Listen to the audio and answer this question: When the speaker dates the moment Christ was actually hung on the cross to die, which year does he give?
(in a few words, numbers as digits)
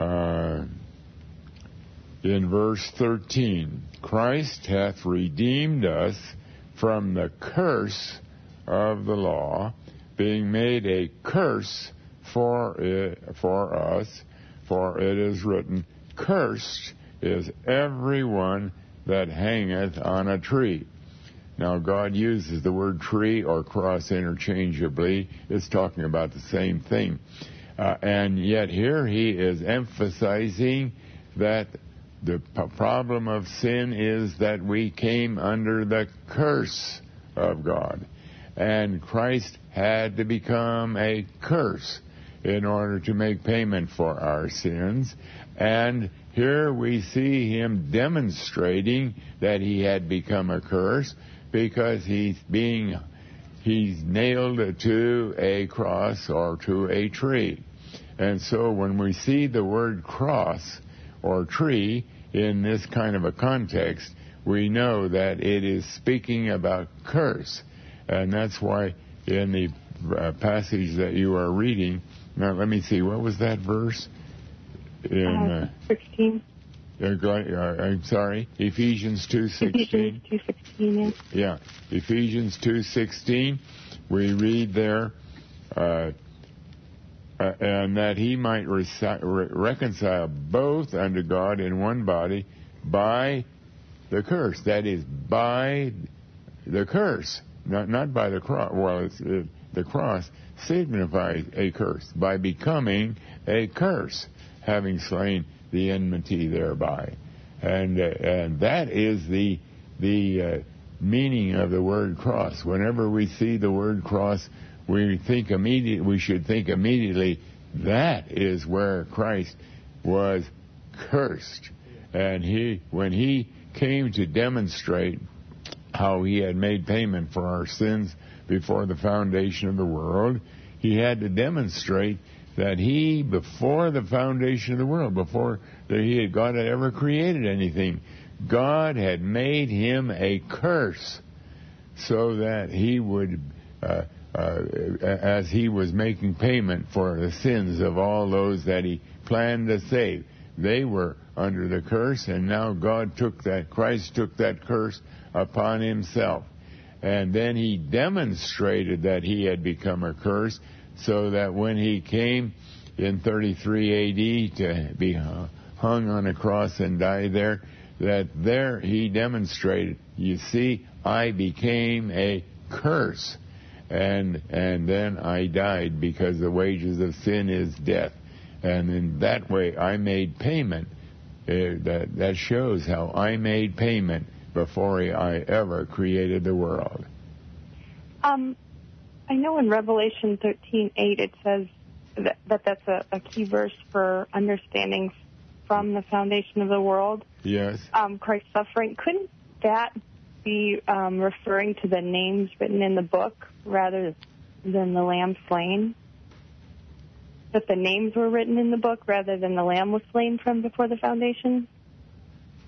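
33 AD.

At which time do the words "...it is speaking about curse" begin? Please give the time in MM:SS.
01:05.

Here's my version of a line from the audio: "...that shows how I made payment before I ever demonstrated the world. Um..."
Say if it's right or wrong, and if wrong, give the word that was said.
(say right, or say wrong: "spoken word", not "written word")
wrong: "created", not "demonstrated".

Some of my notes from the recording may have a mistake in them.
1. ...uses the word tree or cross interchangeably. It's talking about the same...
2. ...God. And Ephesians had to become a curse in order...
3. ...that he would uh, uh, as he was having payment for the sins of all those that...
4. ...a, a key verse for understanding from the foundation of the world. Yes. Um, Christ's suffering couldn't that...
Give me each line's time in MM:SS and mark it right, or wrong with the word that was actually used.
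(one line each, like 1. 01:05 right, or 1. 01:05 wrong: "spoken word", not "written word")
1. 00:22 right
2. 00:37 wrong: "Christ", not "Ephesians"
3. 02:22 wrong: "making", not "having"
4. 03:12 right.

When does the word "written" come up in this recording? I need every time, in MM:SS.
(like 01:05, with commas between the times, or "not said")
00:15, 03:22, 03:28.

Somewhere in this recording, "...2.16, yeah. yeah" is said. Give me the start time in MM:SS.
01:20.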